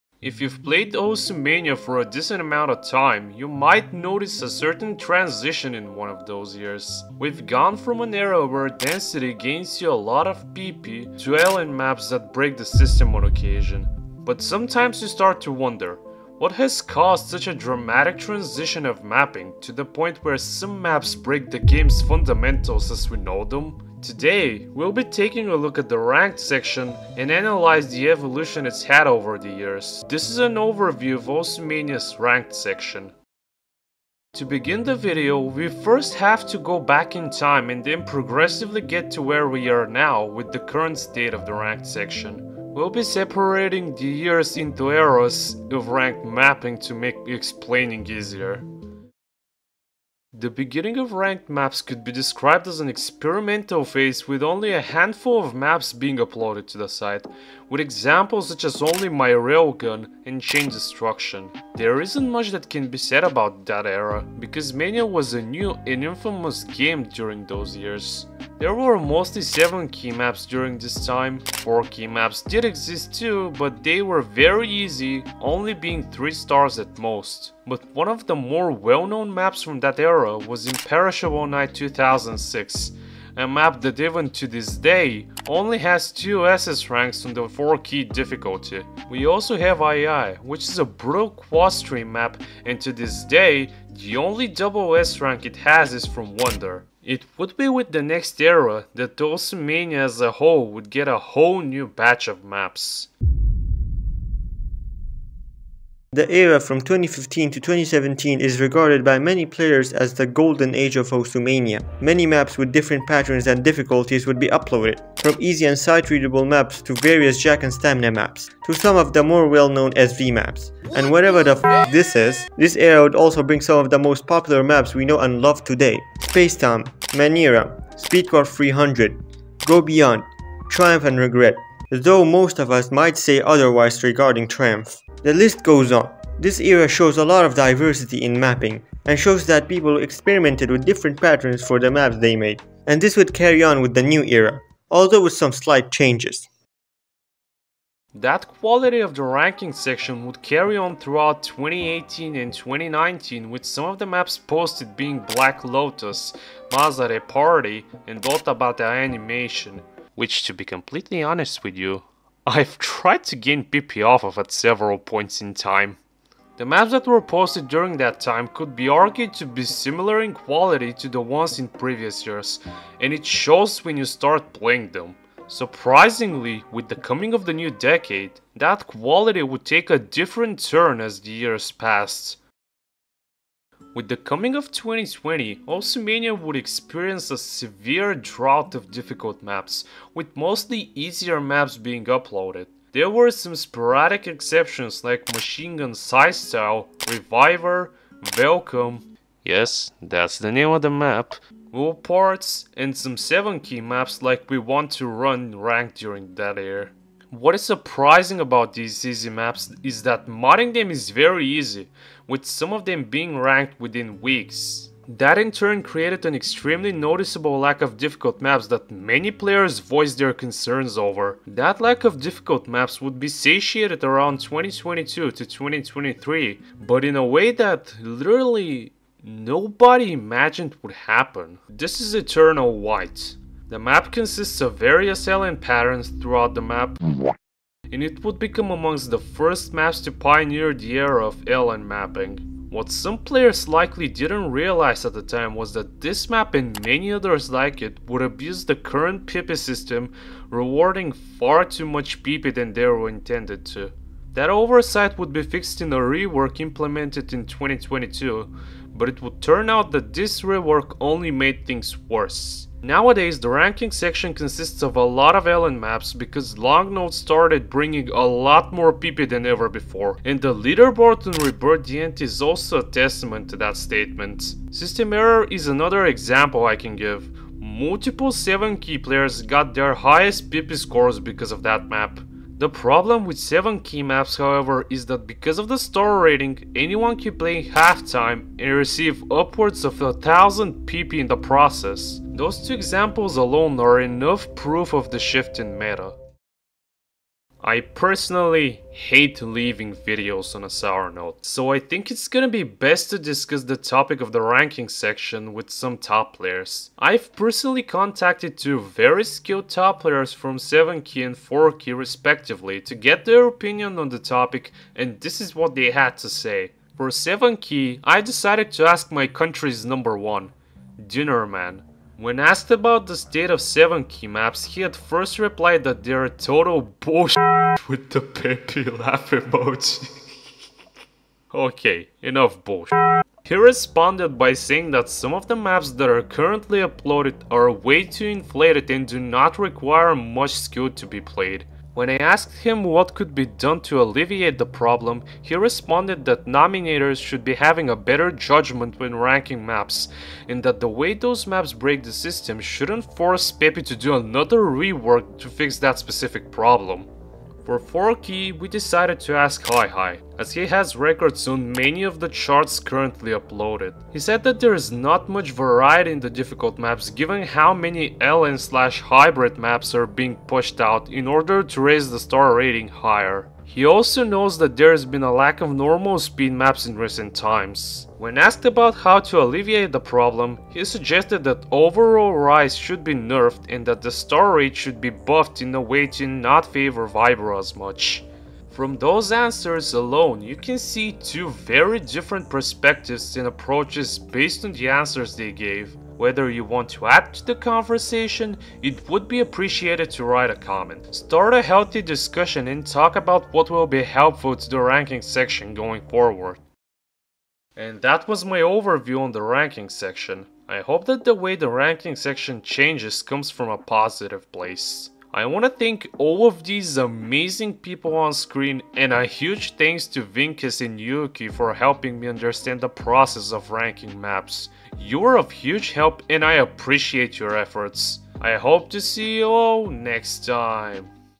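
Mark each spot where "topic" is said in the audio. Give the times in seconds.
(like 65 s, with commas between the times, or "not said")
303 s, 314 s.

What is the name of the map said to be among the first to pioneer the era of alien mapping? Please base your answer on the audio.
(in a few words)
Eternal White.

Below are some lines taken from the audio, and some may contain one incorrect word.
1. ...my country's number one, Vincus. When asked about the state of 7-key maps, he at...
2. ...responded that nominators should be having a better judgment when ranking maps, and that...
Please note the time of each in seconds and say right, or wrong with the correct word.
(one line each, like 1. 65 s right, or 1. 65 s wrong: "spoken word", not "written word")
1. 319 s wrong: "Man", not "Vincus"
2. 345 s right.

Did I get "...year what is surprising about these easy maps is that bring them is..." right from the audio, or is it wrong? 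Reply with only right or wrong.
wrong.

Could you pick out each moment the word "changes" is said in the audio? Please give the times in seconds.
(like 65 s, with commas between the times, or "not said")
145 s, 412 s.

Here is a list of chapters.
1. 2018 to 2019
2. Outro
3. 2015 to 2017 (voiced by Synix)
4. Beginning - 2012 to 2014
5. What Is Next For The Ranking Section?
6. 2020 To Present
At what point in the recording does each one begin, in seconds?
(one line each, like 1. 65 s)
1. 148 s
2. 407 s
3. 103 s
4. 33 s
5. 297 s
6. 182 s.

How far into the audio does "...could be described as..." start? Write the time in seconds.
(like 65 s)
51 s.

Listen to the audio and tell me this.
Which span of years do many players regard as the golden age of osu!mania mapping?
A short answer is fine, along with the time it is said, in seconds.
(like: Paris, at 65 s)
2015 to 2017, at 106 s.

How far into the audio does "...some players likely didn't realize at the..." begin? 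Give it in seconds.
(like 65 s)
242 s.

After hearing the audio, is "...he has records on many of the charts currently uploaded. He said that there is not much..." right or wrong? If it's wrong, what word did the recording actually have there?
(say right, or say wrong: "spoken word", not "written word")
right.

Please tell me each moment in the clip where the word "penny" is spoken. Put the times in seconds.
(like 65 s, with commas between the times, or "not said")
not said.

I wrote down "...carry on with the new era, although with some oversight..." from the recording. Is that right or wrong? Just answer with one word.
wrong.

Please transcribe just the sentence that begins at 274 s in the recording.
System error is another example I can give.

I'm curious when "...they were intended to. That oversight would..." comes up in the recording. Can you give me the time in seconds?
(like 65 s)
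252 s.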